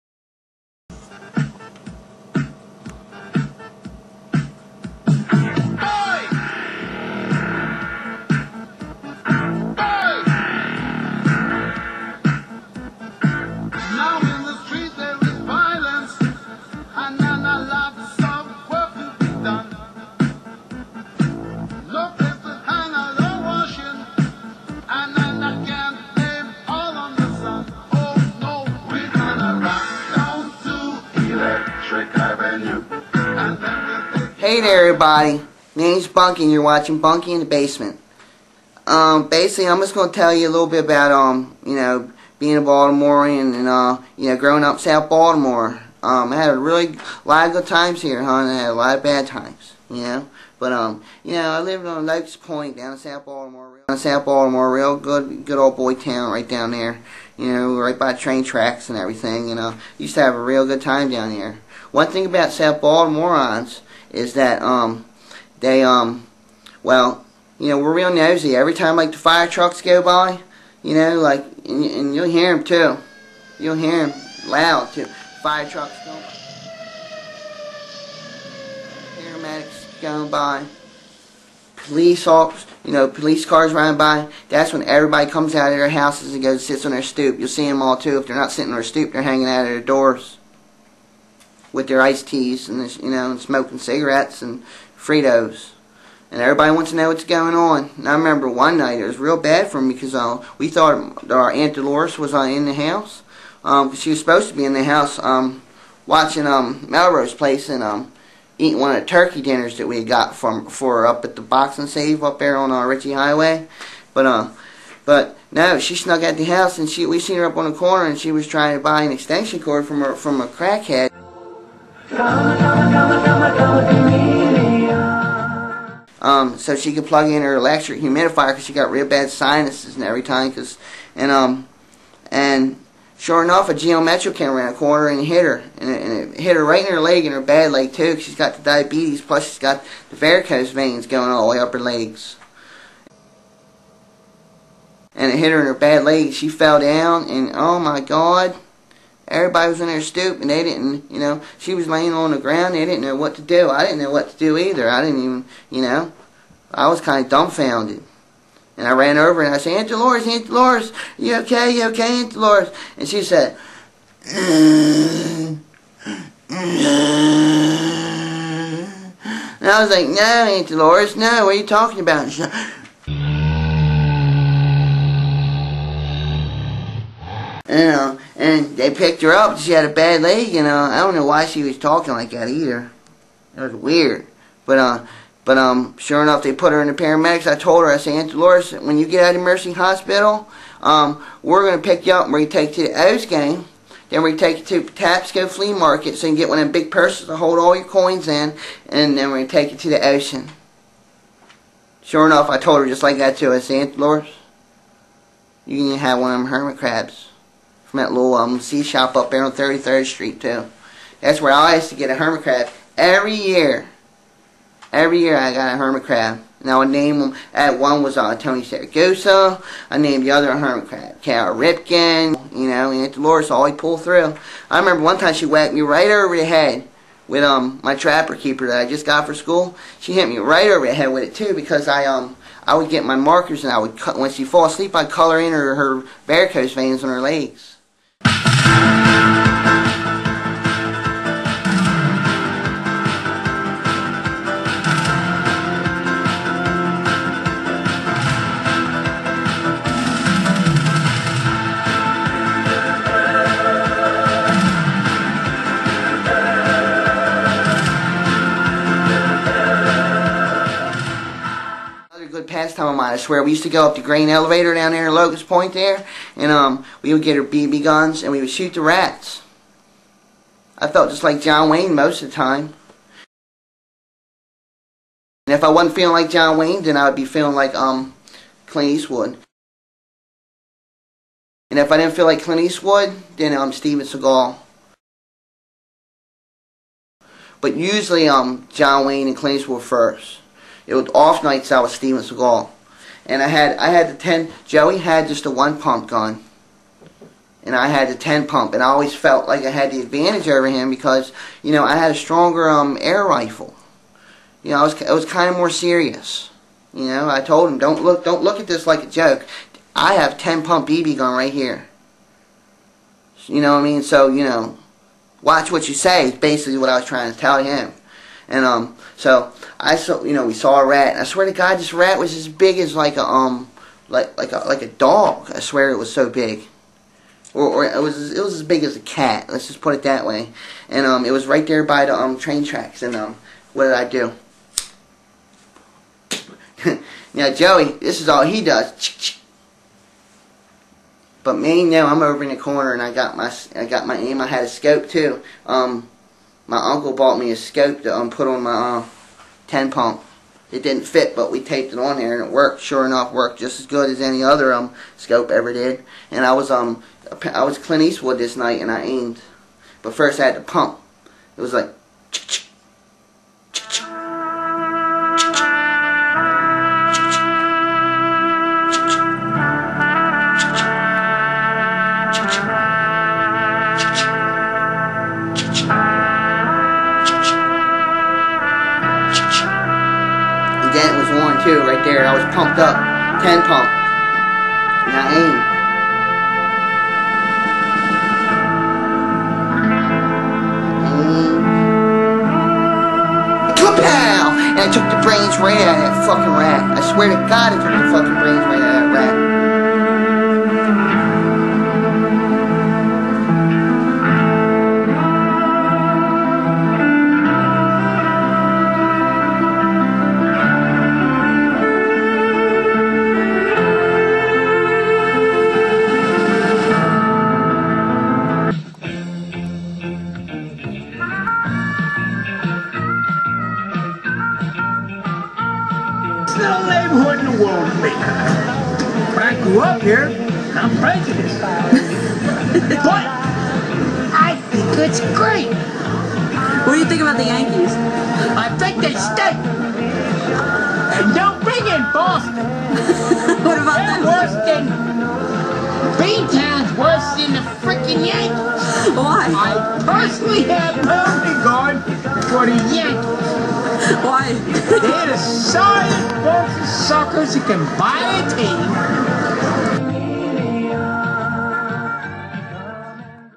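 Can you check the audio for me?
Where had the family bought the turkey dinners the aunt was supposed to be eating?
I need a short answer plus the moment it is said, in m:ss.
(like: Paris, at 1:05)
Box and Save, at 1:51.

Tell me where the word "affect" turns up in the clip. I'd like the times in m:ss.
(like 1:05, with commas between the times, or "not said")
not said.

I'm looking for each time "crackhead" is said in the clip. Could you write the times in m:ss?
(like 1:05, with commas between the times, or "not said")
2:00.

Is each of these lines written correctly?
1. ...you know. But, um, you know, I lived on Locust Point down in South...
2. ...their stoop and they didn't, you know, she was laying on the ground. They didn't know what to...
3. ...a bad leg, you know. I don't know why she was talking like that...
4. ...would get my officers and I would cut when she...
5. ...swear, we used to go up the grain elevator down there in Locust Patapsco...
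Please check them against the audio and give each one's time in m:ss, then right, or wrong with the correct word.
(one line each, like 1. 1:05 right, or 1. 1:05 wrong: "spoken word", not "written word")
1. 0:49 right
2. 2:29 right
3. 2:59 right
4. 3:52 wrong: "markers", not "officers"
5. 4:23 wrong: "Point", not "Patapsco".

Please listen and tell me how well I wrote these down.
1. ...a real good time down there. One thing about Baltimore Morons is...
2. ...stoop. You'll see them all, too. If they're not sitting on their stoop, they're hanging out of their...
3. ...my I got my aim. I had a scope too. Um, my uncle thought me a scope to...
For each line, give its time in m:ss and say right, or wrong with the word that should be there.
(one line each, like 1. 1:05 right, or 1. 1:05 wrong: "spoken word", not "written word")
1. 1:00 wrong: "South", not "Baltimore"
2. 1:27 right
3. 5:43 wrong: "bought", not "thought".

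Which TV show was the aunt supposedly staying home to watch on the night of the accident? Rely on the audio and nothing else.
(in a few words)
Melrose Place.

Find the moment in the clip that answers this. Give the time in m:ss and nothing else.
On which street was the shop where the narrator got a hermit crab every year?
3:29.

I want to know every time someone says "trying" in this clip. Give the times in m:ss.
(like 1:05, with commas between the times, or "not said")
1:58, 5:17.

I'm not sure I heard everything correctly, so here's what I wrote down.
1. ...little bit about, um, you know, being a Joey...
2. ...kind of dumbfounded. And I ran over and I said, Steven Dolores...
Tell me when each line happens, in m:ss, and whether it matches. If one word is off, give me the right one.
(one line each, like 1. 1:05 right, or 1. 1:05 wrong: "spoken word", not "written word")
1. 0:40 wrong: "Baltimorean", not "Joey"
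2. 2:37 wrong: "Aunt", not "Steven".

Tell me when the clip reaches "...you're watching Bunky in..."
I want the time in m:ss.
0:36.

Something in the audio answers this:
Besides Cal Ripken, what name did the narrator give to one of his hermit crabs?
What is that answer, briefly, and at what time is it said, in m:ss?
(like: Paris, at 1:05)
Tony Saragosa, at 3:38.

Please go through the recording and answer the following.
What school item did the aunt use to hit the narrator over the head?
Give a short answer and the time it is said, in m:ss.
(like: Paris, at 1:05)
Trapper keeper, at 3:47.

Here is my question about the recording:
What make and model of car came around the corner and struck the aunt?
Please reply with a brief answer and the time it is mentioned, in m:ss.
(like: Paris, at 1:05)
Geo Metro, at 2:13.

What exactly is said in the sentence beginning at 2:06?
Um, so she could plug in her electric humidifier because she got real bad sinuses and every time.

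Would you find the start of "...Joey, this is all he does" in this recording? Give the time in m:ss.
5:37.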